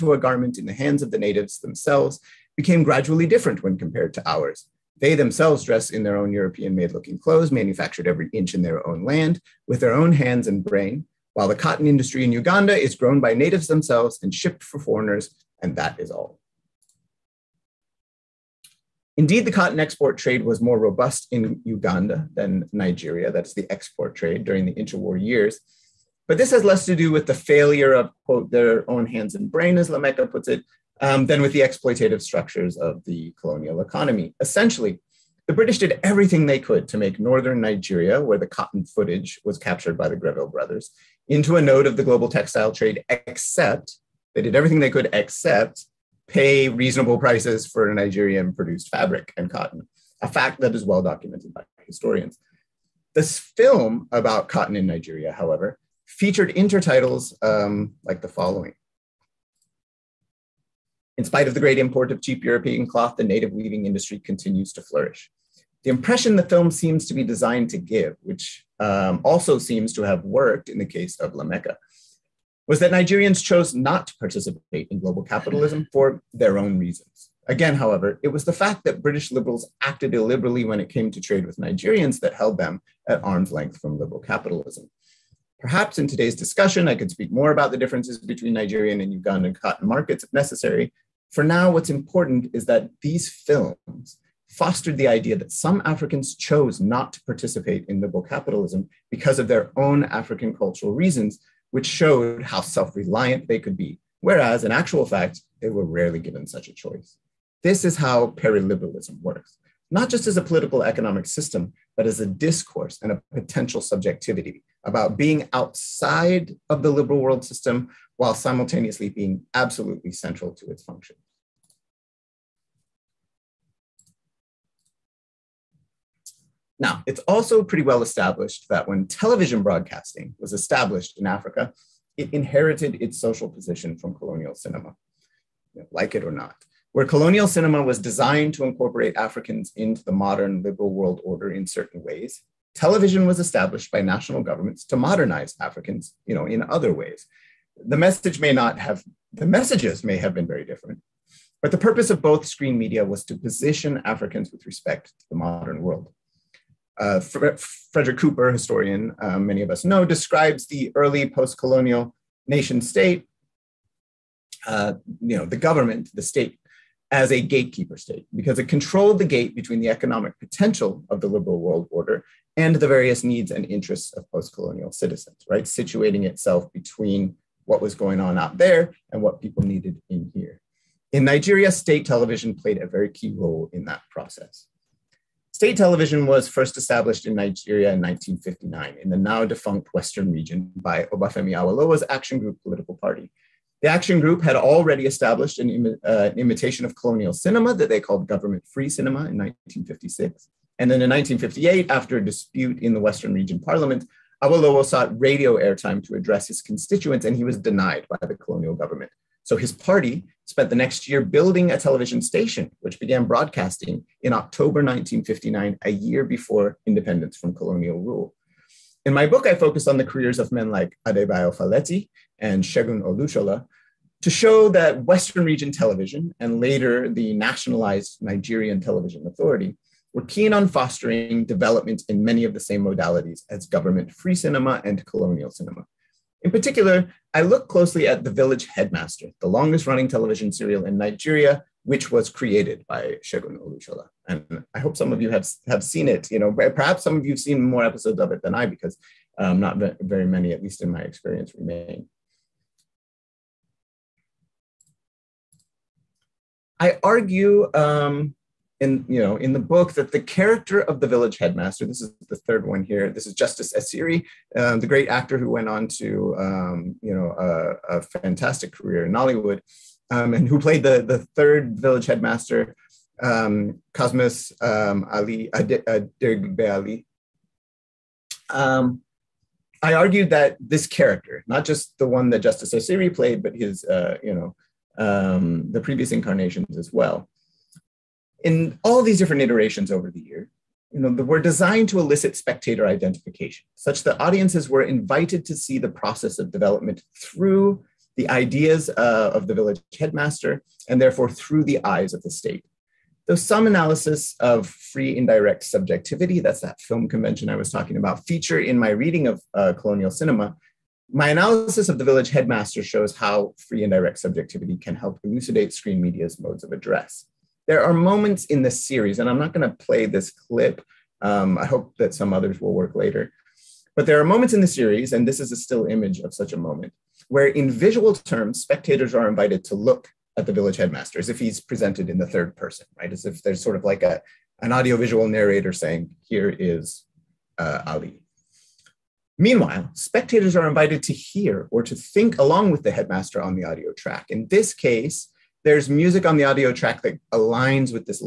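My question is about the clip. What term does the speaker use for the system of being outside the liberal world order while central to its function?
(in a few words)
periliberalism.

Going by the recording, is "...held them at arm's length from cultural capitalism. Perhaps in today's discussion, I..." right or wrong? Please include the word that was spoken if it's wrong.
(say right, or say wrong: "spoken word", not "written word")
wrong: "liberal", not "cultural".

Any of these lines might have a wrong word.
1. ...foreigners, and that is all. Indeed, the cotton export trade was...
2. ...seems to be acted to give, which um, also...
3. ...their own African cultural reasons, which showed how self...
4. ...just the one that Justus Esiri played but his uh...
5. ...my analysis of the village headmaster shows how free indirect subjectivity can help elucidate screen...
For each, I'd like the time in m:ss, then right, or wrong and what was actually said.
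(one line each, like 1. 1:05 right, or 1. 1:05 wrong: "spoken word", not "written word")
1. 0:14 right
2. 1:06 wrong: "designed", not "acted"
3. 1:39 right
4. 4:41 right
5. 5:11 right.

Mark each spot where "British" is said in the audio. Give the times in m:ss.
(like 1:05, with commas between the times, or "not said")
0:35, 1:19.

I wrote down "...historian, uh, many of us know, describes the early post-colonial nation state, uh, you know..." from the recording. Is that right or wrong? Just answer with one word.
right.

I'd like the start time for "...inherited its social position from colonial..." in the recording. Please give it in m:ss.
2:12.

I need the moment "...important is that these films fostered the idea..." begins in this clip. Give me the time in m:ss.
1:31.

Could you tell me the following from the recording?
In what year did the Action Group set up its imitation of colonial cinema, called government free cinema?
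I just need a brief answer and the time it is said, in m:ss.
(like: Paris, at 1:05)
1956, at 3:19.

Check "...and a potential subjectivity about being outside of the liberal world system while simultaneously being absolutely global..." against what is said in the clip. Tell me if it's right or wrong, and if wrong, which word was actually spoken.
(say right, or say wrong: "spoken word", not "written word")
wrong: "central", not "global".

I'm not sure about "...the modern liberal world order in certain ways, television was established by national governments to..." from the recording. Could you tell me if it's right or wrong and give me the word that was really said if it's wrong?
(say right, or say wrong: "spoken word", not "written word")
right.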